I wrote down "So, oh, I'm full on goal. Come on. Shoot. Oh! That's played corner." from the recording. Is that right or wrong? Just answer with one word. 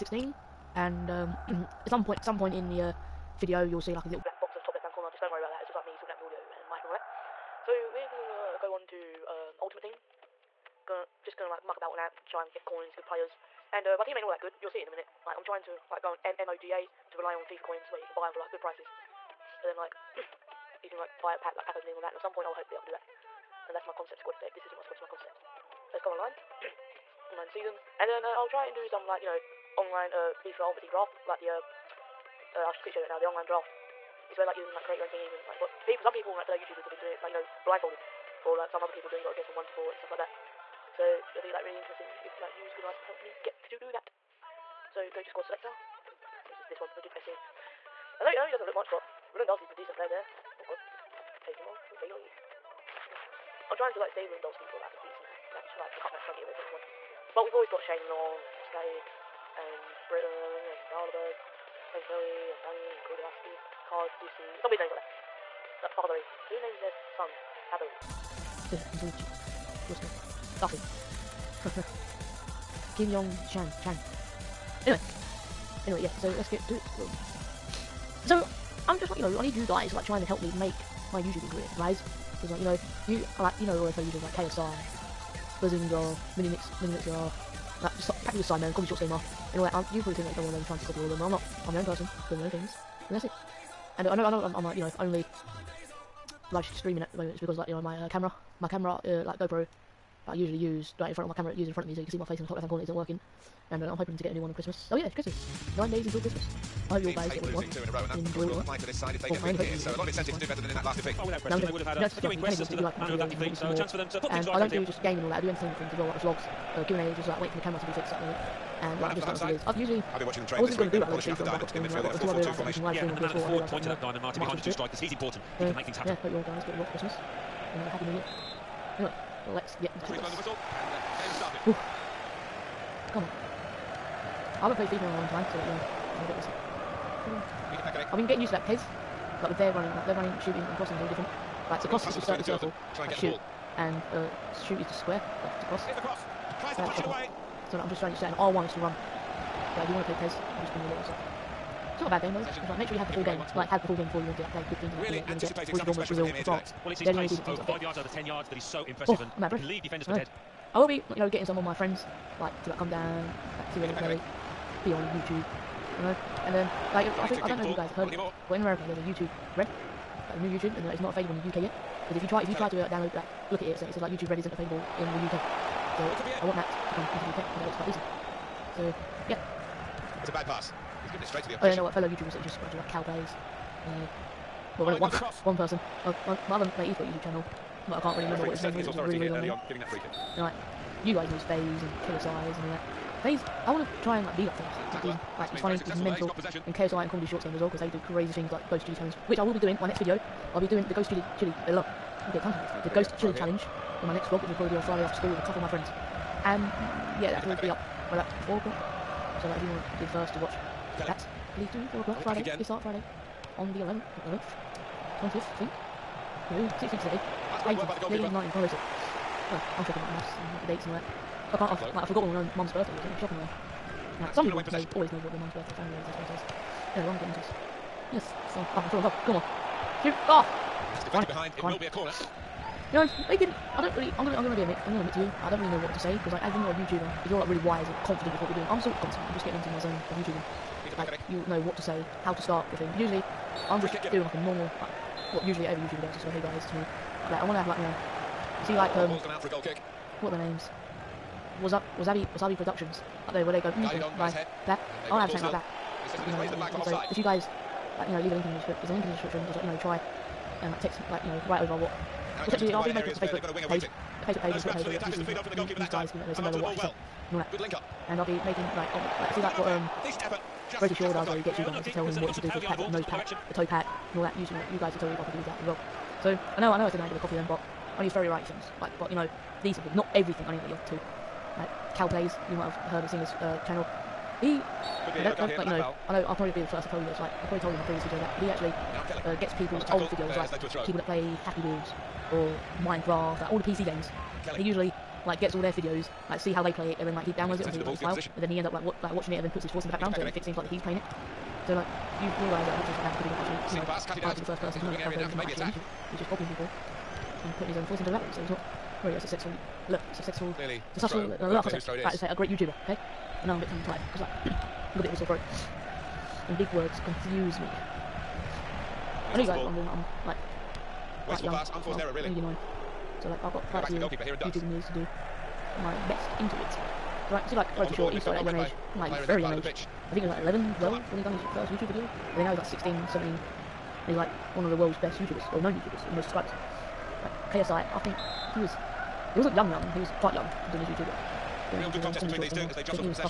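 wrong.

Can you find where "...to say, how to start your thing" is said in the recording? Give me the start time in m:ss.
4:01.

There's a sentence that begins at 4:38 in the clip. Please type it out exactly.
Like, but you know, decent things, not everything.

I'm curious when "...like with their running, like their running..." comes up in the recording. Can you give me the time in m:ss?
2:19.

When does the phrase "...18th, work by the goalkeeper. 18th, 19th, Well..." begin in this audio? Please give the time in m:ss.
3:37.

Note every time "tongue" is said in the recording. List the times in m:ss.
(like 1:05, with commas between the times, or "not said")
3:22, 5:13.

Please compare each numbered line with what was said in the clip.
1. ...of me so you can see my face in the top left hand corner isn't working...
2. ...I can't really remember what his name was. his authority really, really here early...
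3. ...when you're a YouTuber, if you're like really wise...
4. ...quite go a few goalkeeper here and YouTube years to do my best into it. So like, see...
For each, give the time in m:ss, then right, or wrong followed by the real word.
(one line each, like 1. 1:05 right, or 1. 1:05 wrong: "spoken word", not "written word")
1. 1:41 right
2. 3:07 right
3. 3:56 right
4. 5:23 right.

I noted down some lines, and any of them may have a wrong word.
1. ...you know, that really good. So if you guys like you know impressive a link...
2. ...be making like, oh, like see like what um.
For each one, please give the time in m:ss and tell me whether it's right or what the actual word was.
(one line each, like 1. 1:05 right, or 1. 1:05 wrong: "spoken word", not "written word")
1. 4:16 wrong: "leave", not "impressive"
2. 4:28 right.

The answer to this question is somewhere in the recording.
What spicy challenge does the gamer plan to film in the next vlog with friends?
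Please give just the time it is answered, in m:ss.
3:18.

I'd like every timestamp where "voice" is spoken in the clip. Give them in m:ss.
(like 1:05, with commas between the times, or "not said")
4:59, 5:07.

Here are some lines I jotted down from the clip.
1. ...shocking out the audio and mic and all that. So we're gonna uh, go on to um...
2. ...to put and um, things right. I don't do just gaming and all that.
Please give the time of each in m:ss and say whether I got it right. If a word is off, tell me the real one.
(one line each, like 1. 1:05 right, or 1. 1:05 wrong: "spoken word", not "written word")
1. 0:05 wrong: "sorting", not "shocking"
2. 1:54 right.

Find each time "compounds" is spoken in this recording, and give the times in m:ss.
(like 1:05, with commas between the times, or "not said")
not said.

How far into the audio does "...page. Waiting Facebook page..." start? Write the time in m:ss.
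4:23.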